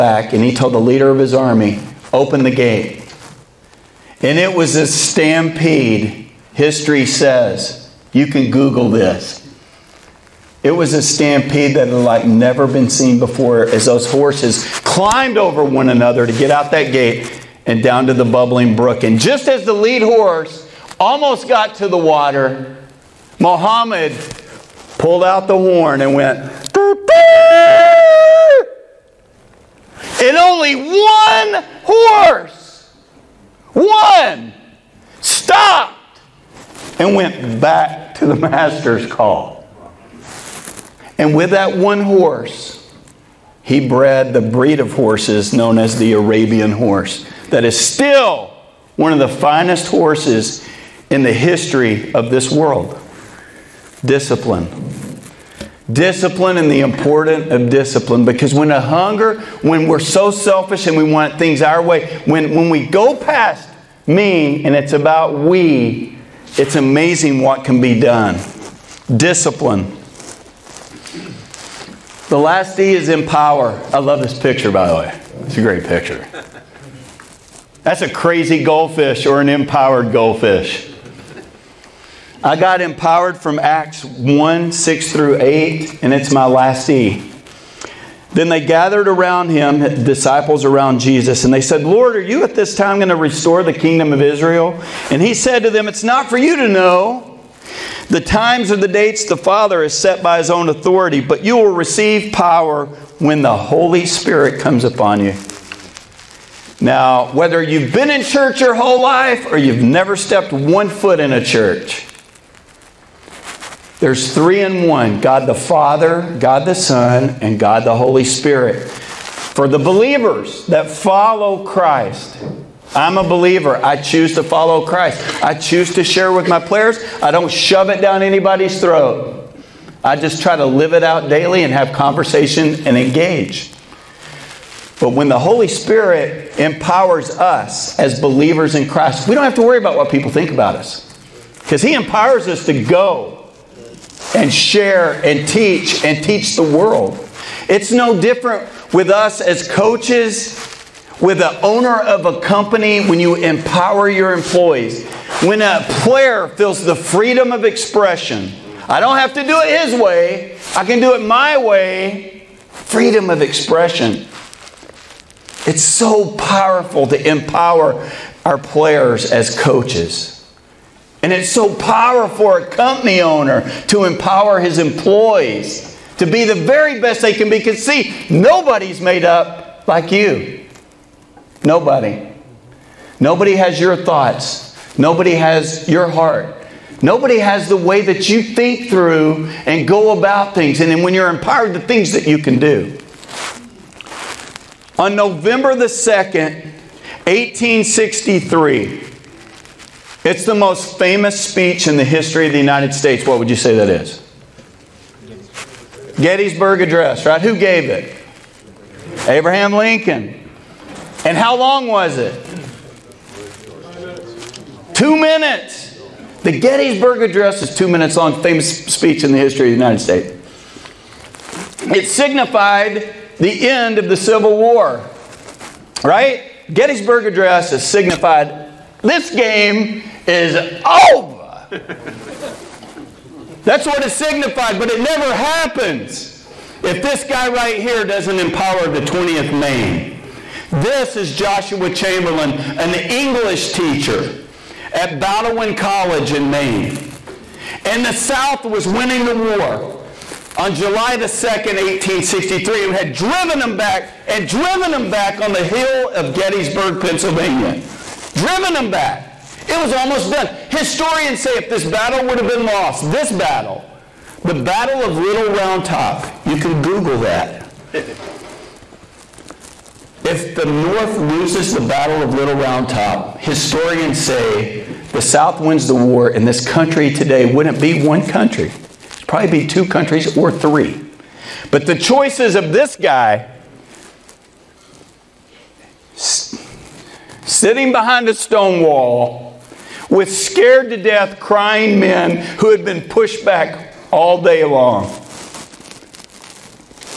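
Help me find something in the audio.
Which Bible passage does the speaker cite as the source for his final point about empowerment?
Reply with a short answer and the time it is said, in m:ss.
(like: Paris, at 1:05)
Acts 1:6-8, at 1:23.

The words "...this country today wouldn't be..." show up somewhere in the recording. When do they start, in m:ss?
4:36.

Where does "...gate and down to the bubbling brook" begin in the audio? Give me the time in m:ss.
0:16.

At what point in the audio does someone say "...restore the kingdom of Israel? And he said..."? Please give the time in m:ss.
1:33.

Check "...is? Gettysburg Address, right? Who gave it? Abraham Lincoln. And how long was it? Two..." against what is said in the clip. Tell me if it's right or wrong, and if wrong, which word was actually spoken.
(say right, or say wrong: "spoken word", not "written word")
right.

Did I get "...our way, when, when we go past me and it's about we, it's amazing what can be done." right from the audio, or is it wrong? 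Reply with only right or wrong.
right.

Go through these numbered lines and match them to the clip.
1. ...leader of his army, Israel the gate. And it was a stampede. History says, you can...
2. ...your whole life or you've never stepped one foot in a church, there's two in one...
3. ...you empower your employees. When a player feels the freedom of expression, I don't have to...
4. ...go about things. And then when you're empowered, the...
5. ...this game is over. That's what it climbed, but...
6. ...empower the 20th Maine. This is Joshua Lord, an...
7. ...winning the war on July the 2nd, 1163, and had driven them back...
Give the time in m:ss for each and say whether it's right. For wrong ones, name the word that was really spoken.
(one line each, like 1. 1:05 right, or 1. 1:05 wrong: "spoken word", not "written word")
1. 0:00 wrong: "Open", not "Israel"
2. 1:48 wrong: "three", not "two"
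3. 2:33 right
4. 3:09 right
5. 3:49 wrong: "signified", not "climbed"
6. 3:58 wrong: "Chamberlain", not "Lord"
7. 4:08 wrong: "1863", not "1163".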